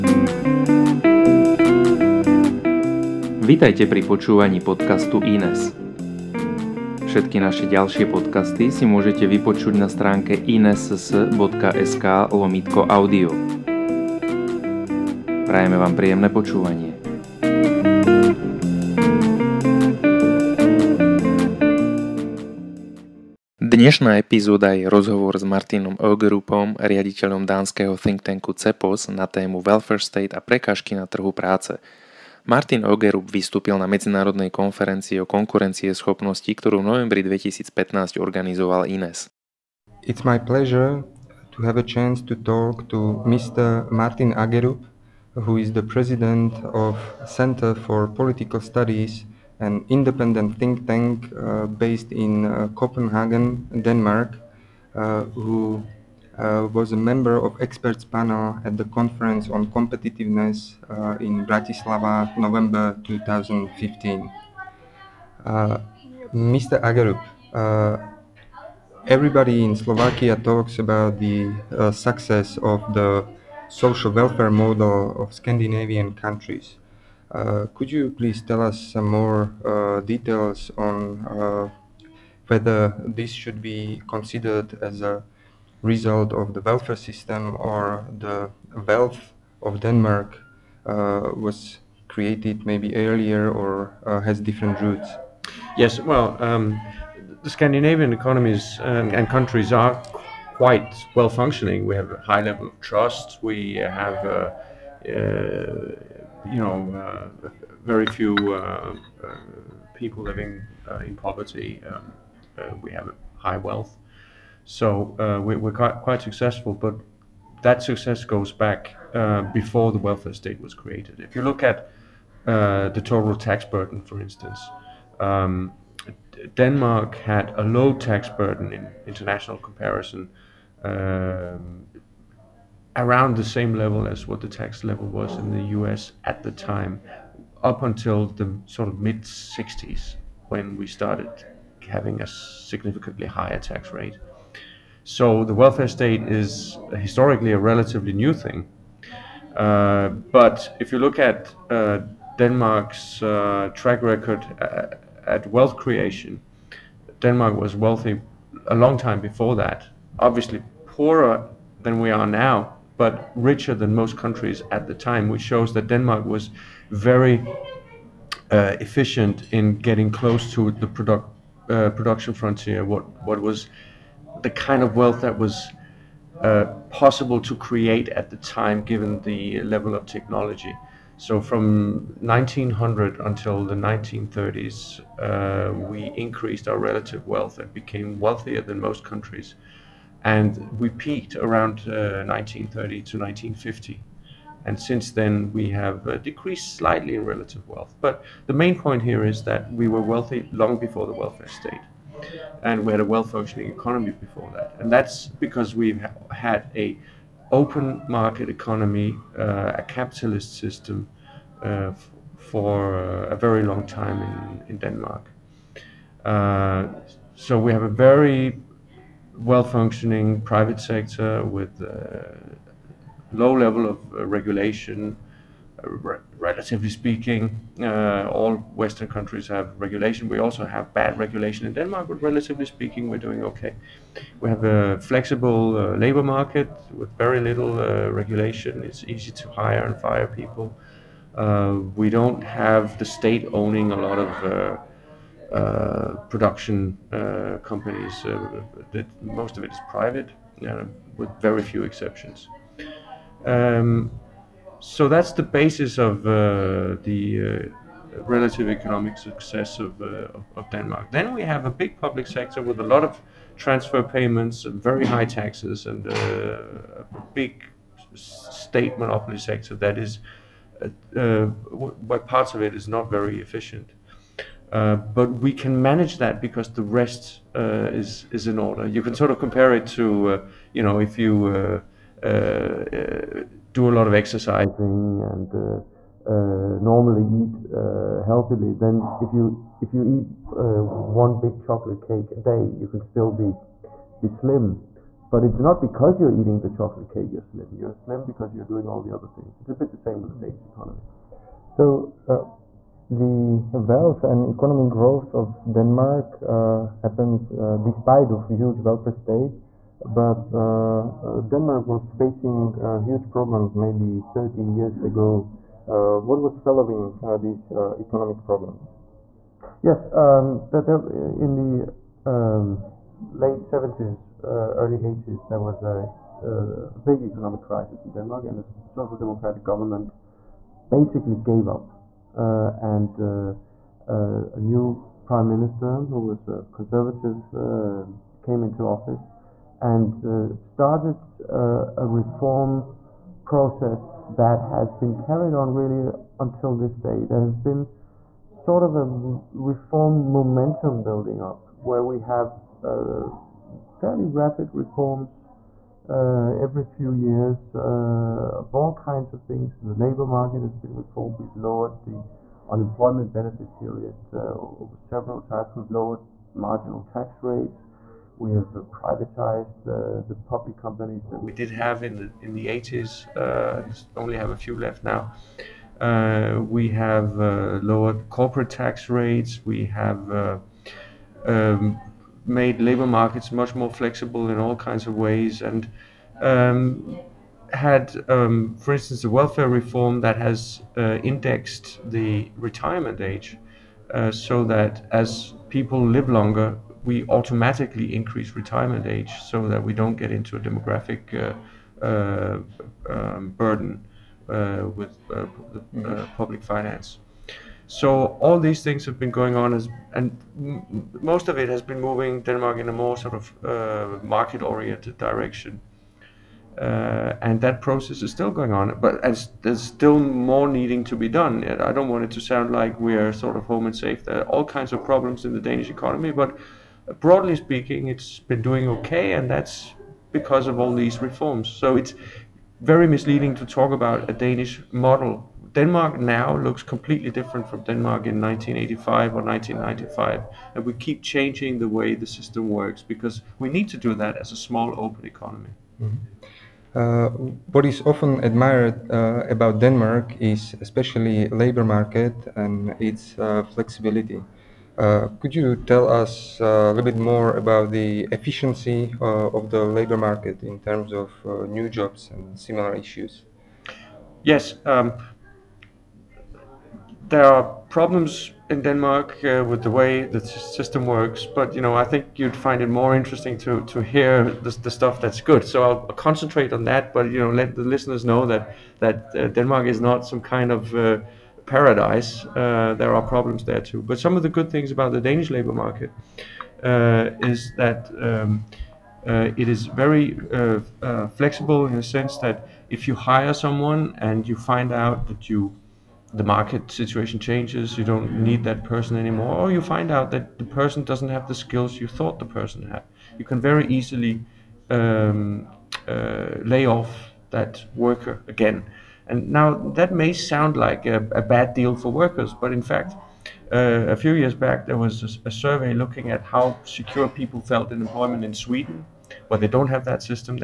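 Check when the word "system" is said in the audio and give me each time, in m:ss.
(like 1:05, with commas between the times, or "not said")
1:26, 3:30, 7:22, 7:50.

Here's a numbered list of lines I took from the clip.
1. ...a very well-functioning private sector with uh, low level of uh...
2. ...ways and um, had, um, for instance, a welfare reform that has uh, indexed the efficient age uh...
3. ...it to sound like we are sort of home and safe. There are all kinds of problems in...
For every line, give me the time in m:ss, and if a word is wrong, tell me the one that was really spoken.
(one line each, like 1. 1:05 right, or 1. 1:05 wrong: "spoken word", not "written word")
1. 3:37 right
2. 6:25 wrong: "retirement", not "efficient"
3. 7:02 right.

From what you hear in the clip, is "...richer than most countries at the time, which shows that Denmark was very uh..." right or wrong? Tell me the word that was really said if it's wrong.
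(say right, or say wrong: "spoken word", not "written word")
right.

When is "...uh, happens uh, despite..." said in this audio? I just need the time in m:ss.
5:06.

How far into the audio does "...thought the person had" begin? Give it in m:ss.
8:22.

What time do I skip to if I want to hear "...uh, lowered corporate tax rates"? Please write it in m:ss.
6:17.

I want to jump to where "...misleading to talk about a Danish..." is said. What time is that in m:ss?
7:13.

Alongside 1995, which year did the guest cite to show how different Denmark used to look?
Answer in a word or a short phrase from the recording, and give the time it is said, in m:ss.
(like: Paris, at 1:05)
1985, at 7:18.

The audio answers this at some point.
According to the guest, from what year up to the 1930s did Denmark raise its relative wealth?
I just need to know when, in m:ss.
3:02.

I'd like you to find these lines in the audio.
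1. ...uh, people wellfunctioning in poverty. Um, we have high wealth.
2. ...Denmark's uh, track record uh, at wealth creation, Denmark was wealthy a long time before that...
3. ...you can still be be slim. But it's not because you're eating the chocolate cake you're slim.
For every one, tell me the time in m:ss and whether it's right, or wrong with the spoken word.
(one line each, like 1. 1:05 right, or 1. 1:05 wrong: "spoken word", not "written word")
1. 1:49 wrong: "living", not "wellfunctioning"
2. 2:32 right
3. 4:52 right.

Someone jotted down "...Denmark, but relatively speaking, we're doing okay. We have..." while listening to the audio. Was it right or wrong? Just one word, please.
right.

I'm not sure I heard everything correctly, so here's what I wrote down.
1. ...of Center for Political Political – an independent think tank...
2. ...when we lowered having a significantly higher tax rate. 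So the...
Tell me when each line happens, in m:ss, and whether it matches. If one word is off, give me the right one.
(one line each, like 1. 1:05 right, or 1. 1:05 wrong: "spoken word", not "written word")
1. 0:46 wrong: "Studies", not "Political"
2. 2:20 wrong: "started", not "lowered".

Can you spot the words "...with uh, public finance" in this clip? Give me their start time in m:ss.
6:44.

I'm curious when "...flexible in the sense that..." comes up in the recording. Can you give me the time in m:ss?
8:11.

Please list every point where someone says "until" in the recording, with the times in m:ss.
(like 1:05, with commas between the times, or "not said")
2:17, 3:03, 5:46.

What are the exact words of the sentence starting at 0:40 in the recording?
It's my pleasure to have a chance to talk to Mr.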